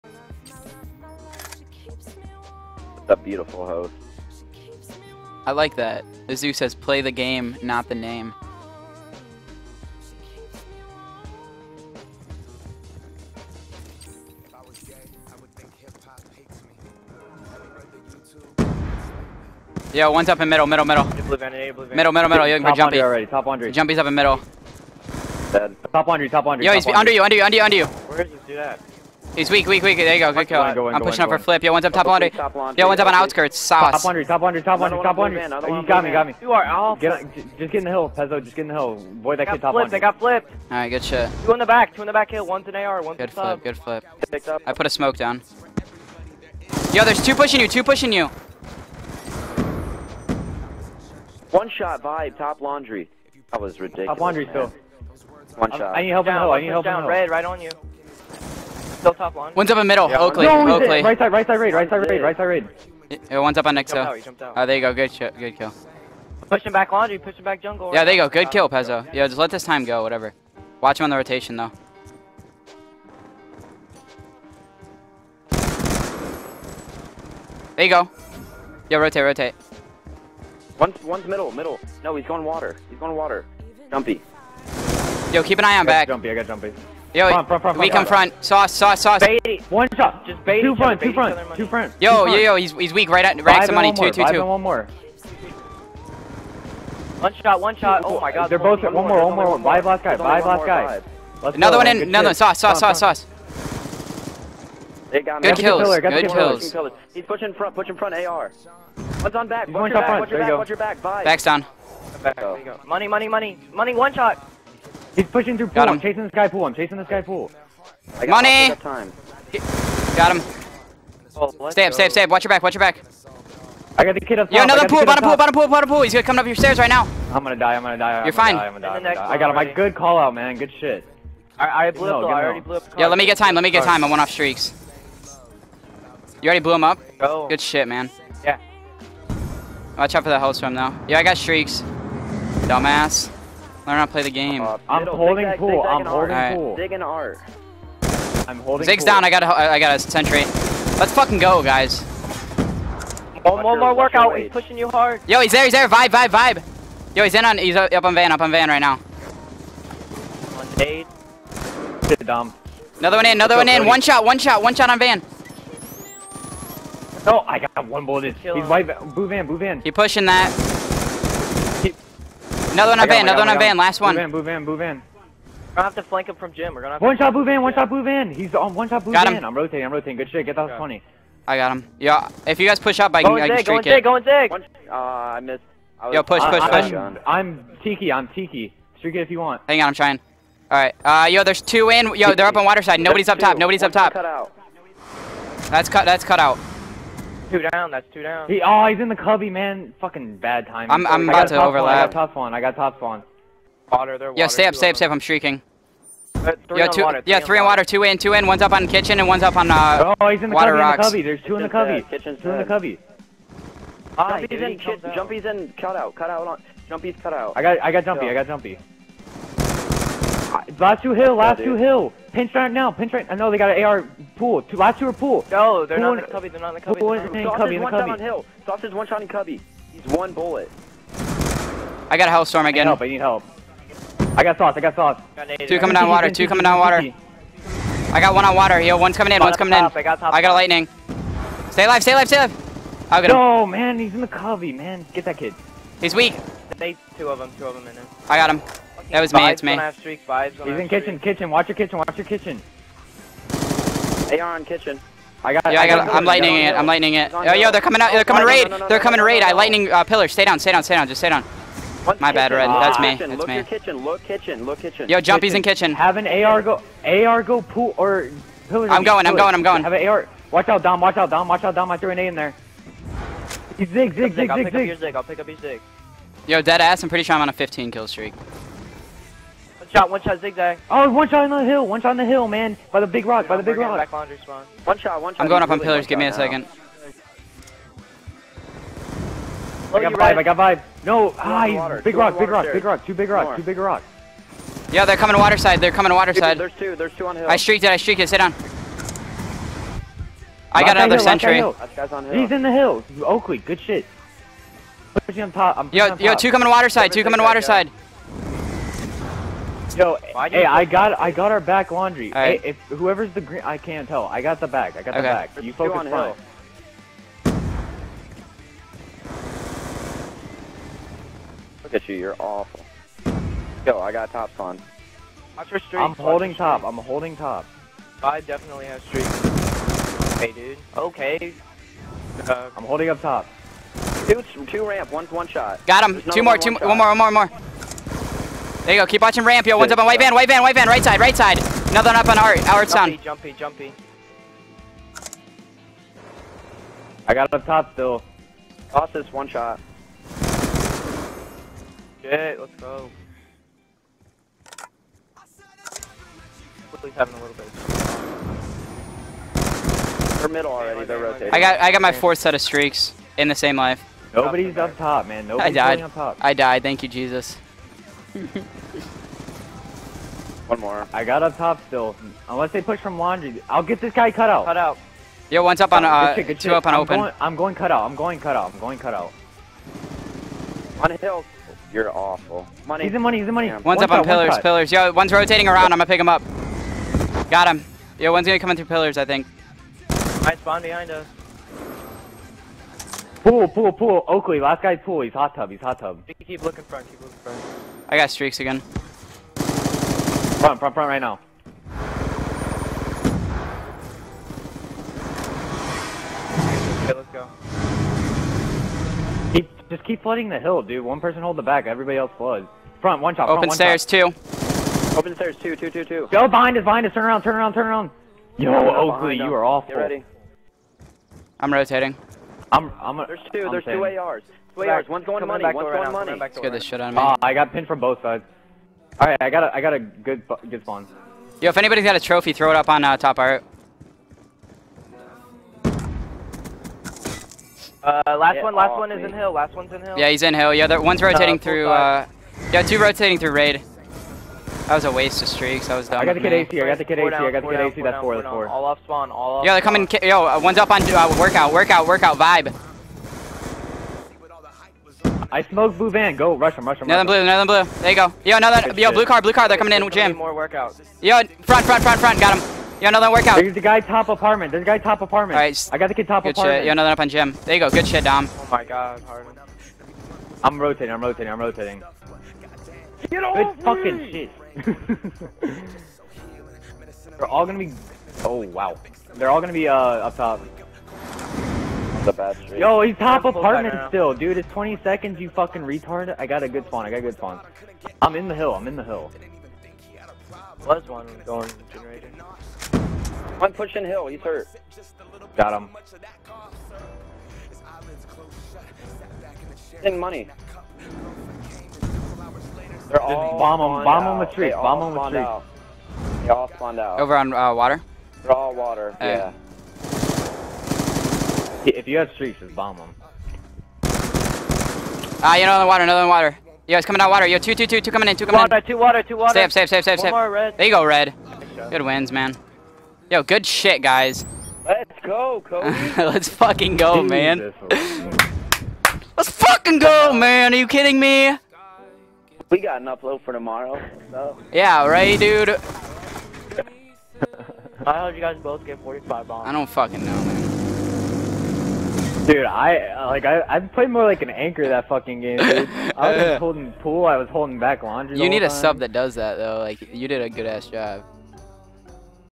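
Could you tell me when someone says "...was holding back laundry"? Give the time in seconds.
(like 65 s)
547 s.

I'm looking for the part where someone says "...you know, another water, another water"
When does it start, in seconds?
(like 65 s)
515 s.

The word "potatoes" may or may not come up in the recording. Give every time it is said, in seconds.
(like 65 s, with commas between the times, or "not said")
not said.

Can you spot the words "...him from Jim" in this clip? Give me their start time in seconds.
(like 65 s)
176 s.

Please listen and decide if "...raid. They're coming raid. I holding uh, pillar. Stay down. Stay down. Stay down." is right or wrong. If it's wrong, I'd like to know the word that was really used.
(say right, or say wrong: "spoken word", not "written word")
wrong: "lightning", not "holding".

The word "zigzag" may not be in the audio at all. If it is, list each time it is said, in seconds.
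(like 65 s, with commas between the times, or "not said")
145 s, 280 s.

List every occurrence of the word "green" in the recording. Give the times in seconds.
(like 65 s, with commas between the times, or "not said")
313 s.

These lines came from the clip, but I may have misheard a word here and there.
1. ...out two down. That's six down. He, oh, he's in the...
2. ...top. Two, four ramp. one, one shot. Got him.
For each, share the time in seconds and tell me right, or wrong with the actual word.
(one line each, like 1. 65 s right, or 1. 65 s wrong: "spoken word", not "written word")
1. 196 s wrong: "two", not "six"
2. 333 s wrong: "two", not "four".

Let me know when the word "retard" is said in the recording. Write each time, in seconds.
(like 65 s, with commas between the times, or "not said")
485 s.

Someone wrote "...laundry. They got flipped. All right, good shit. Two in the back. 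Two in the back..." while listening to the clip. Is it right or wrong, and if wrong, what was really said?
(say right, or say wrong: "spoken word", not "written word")
right.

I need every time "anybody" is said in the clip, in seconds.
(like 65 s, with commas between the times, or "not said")
431 s.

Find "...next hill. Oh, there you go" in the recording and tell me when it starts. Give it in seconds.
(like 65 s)
63 s.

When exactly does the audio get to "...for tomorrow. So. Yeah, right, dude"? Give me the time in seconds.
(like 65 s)
533 s.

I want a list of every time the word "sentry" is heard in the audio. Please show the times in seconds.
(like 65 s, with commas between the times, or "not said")
149 s, 301 s.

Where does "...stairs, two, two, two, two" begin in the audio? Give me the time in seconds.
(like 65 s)
415 s.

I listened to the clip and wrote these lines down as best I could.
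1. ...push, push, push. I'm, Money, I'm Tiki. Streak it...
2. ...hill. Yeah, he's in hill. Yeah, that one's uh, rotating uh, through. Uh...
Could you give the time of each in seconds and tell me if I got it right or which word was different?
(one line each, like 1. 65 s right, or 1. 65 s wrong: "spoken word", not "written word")
1. 186 s wrong: "Tiki", not "Money"
2. 440 s right.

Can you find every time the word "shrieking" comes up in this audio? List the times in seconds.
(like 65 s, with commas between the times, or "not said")
205 s.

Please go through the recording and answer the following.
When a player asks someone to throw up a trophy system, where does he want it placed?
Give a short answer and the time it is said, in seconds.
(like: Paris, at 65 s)
Top art, at 433 s.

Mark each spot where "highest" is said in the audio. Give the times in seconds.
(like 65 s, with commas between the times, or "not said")
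not said.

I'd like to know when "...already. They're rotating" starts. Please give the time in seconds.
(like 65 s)
360 s.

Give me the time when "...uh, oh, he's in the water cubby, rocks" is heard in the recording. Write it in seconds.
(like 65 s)
209 s.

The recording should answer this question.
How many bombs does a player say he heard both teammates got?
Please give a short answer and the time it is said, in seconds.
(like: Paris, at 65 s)
45, at 539 s.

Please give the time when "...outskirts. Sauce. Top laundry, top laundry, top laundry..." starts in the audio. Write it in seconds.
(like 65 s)
33 s.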